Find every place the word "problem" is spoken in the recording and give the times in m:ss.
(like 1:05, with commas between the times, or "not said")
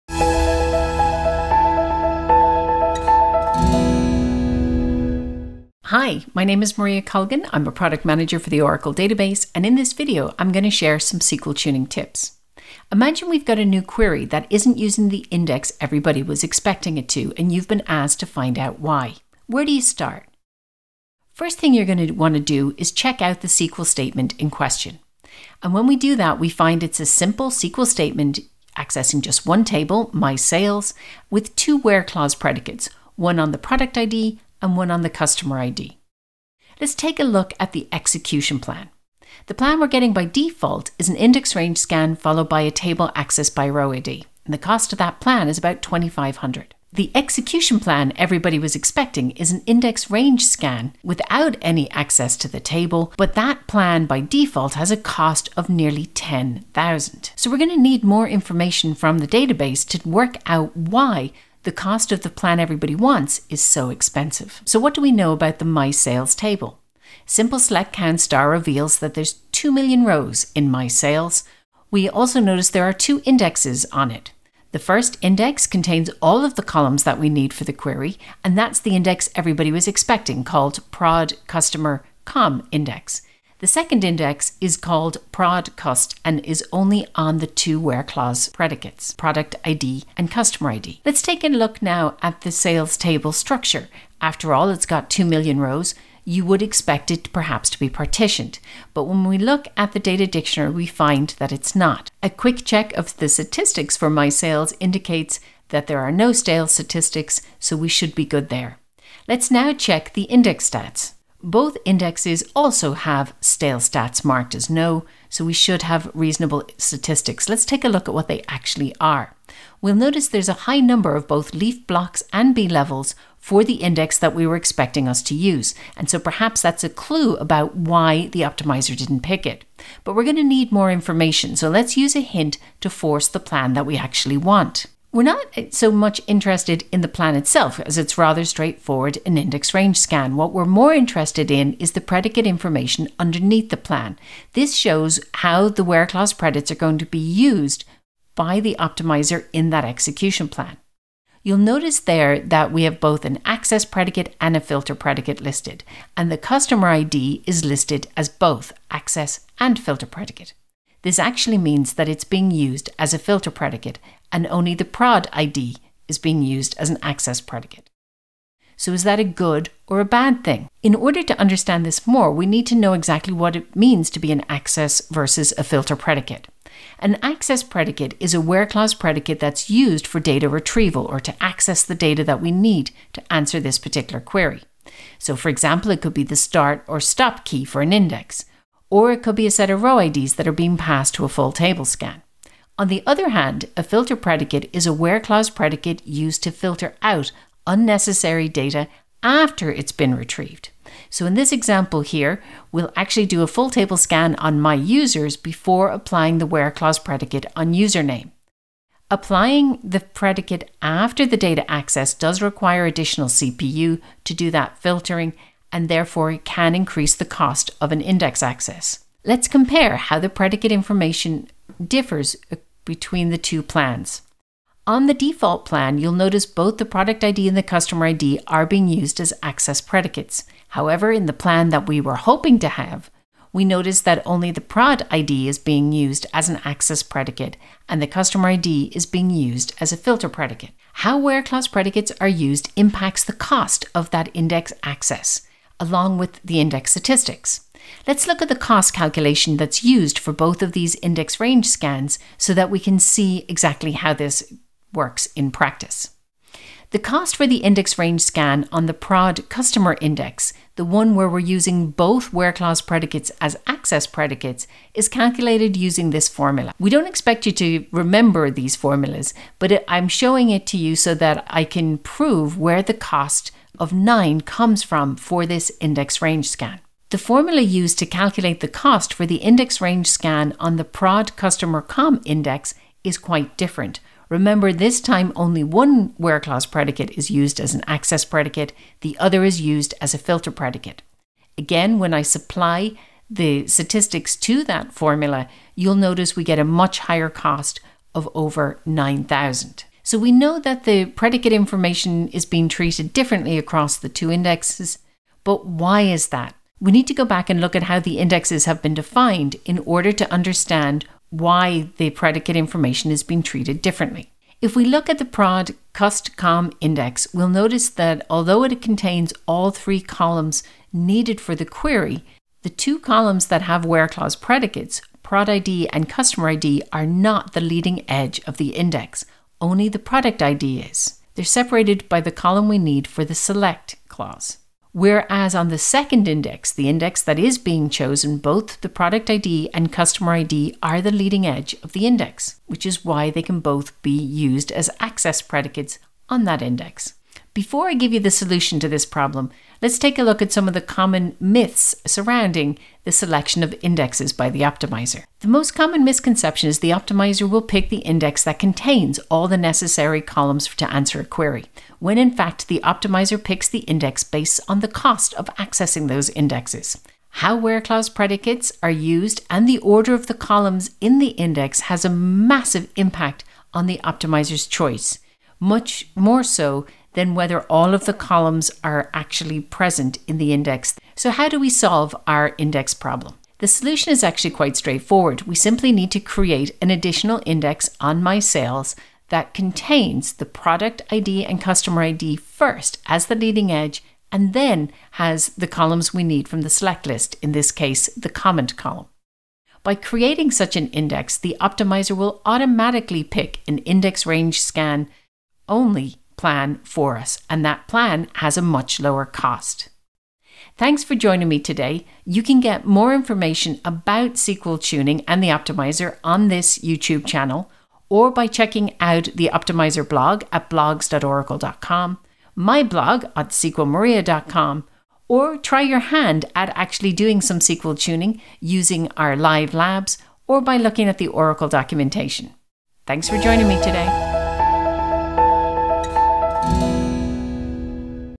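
5:49, 6:22.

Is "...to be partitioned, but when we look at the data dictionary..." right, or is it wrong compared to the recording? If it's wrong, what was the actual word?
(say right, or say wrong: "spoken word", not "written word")
right.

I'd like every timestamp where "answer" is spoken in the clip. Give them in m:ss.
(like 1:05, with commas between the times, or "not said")
3:03, 6:00.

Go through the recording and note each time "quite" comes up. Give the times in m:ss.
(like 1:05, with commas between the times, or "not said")
4:43, 6:24.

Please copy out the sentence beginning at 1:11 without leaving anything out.
We also notice there are two indexes on it.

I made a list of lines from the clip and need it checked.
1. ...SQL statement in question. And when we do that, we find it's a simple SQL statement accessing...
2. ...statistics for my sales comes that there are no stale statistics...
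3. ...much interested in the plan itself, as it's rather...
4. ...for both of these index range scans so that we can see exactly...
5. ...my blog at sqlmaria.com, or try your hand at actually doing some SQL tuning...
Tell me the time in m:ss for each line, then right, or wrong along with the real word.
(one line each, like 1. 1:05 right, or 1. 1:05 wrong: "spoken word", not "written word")
1. 0:23 right
2. 1:43 wrong: "indicates", not "comes"
3. 2:15 right
4. 4:10 right
5. 7:02 right.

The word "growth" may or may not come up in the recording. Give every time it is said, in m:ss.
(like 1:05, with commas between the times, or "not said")
not said.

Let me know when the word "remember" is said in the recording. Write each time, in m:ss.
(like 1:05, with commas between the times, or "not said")
4:27, 4:44.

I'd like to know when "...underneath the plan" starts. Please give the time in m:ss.
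2:23.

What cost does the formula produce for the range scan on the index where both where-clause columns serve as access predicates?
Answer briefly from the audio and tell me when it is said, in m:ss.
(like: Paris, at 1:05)
9, at 4:33.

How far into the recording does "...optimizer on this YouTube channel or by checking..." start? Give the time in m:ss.
6:55.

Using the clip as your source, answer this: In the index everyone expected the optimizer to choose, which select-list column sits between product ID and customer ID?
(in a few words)
comment.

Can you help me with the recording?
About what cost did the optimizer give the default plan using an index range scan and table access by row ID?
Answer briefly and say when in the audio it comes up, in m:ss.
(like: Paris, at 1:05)
2500, at 0:45.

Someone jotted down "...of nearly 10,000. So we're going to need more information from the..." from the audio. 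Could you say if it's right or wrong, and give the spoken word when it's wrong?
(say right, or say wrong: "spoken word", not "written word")
right.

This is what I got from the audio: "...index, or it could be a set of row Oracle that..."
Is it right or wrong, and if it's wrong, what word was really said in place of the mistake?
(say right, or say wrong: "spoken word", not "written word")
wrong: "IDs", not "Oracle".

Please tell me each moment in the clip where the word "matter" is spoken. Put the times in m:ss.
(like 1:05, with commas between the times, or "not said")
not said.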